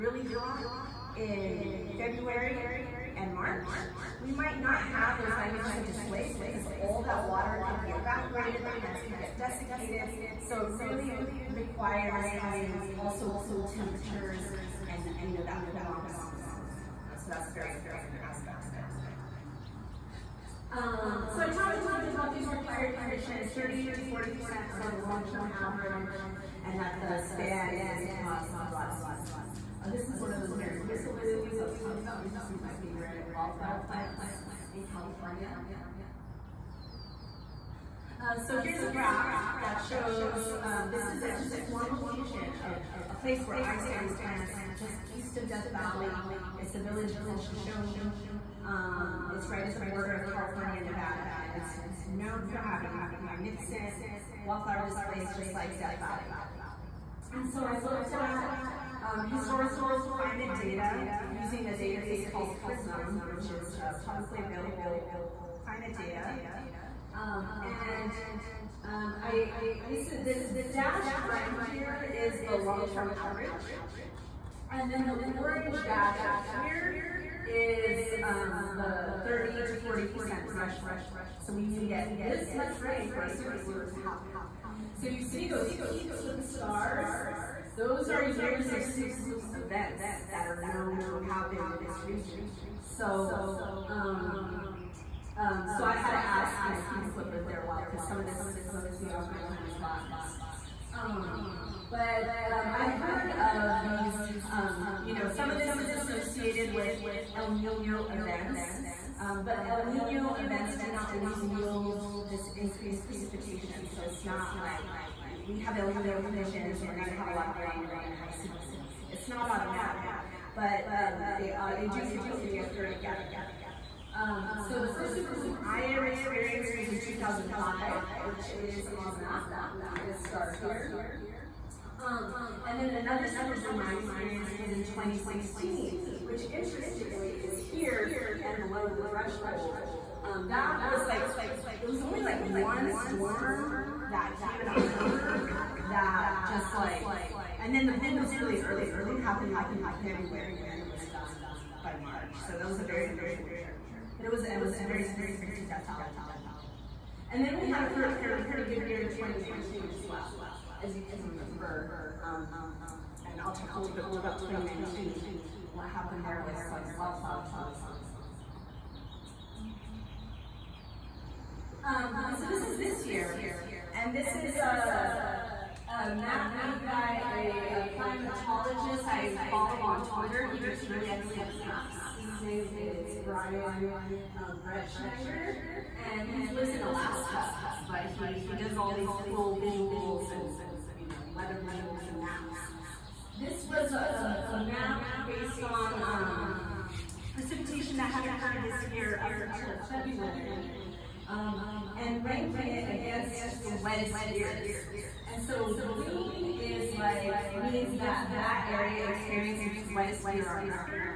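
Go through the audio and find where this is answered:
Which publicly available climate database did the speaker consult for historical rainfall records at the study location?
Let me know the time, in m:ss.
1:02.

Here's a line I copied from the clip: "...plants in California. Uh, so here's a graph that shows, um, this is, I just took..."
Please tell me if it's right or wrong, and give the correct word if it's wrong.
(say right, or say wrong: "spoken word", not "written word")
right.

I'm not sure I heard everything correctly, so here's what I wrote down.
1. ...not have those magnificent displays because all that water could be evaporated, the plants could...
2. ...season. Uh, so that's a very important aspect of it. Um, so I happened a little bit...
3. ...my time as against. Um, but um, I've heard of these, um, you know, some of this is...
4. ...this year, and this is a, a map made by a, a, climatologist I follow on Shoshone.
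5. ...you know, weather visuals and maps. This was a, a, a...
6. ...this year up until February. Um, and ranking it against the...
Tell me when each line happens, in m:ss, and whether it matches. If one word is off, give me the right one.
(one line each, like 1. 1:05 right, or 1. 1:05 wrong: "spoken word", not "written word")
1. 0:04 right
2. 0:16 wrong: "talked", not "happened"
3. 1:39 wrong: "botanist", not "against"
4. 2:52 wrong: "Twitter", not "Shoshone"
5. 3:10 right
6. 3:18 right.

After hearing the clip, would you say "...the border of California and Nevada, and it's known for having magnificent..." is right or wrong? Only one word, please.
right.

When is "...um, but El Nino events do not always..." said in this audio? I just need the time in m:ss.
1:49.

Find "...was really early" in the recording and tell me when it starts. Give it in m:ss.
2:28.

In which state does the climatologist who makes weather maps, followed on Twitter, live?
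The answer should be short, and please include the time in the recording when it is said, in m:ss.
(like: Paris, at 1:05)
Alaska, at 3:06.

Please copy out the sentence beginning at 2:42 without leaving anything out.
Um, and I'll talk a little bit more about 2019, what happened there with some wildflower tourism.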